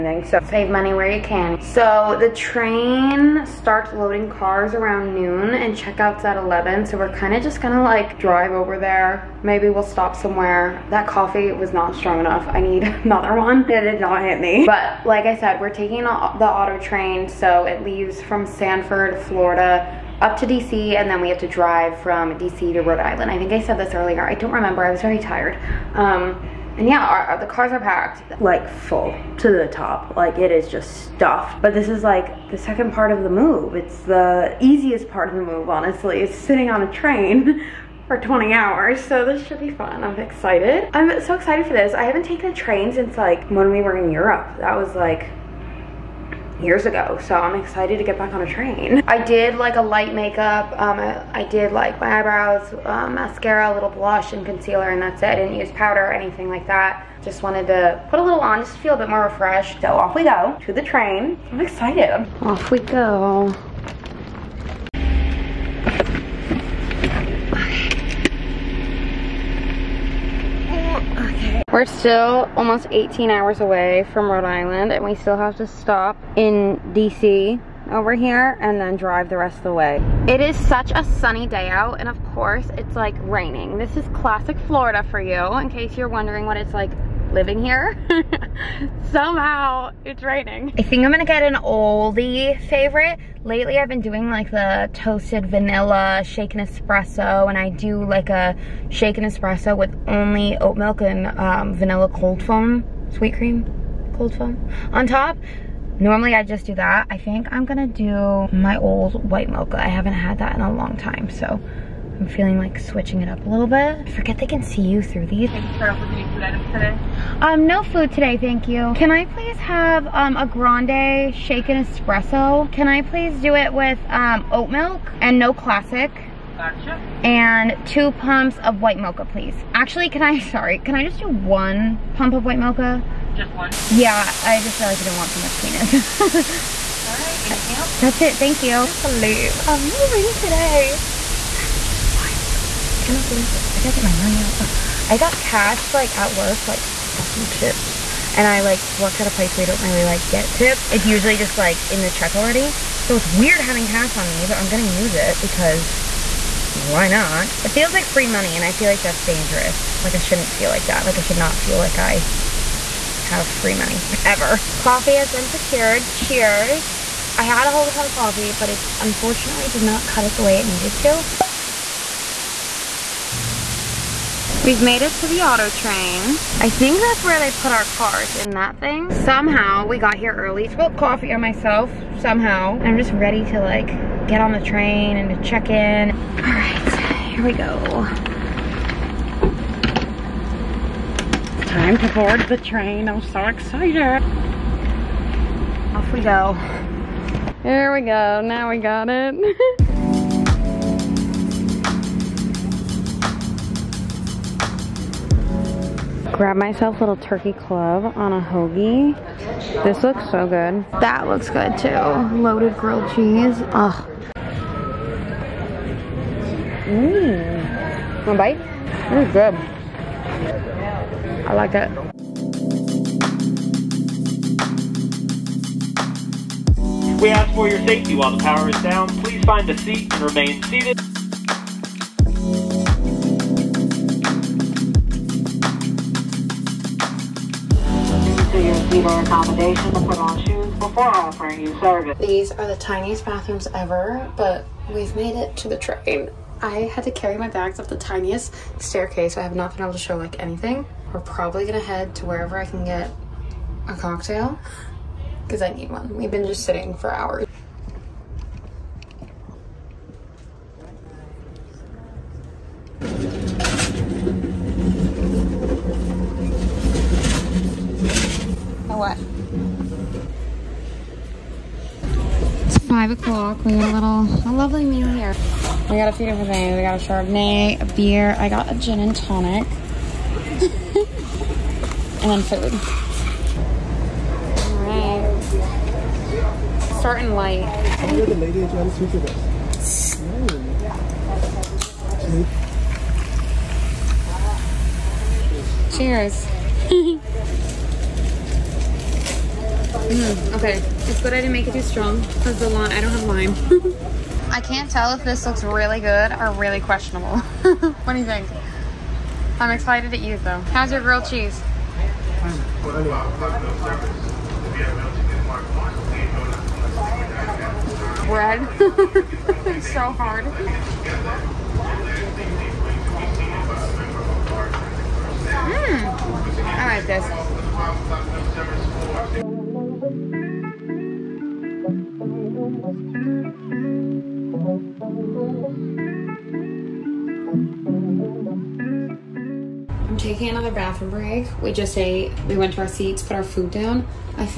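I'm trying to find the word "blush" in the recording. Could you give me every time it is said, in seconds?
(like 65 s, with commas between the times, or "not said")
53 s.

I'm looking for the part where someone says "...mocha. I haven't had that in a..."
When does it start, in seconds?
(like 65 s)
109 s.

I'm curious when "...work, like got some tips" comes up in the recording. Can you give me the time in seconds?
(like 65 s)
146 s.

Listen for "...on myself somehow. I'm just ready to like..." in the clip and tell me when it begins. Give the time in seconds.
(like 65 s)
181 s.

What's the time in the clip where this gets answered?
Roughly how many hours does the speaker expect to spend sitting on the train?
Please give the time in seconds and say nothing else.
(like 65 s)
38 s.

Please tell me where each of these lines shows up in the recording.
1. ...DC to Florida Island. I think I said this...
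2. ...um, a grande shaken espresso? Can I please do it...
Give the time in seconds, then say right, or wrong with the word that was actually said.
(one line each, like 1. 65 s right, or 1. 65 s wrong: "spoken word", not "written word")
1. 22 s wrong: "Rhode", not "Florida"
2. 120 s right.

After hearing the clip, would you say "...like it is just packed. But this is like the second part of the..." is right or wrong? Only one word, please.
wrong.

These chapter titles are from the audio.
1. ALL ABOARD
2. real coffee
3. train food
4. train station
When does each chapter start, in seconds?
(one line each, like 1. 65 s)
1. 221 s
2. 64 s
3. 260 s
4. 170 s.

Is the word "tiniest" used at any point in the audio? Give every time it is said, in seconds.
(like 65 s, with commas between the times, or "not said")
242 s, 247 s.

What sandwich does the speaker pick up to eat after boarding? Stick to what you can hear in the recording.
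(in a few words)
turkey club.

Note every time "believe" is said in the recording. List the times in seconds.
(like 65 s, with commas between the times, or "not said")
138 s, 143 s.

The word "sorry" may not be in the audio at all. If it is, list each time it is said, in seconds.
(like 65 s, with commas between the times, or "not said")
130 s.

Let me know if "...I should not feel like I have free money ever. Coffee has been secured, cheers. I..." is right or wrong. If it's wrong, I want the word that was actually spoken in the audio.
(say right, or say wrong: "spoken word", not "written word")
right.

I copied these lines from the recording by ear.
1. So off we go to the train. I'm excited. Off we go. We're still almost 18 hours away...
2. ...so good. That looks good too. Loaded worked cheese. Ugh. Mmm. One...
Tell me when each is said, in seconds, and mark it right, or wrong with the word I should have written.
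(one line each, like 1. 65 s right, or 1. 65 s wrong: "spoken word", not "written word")
1. 59 s right
2. 210 s wrong: "grilled", not "worked".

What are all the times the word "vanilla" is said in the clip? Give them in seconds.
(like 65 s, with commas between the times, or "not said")
95 s, 101 s.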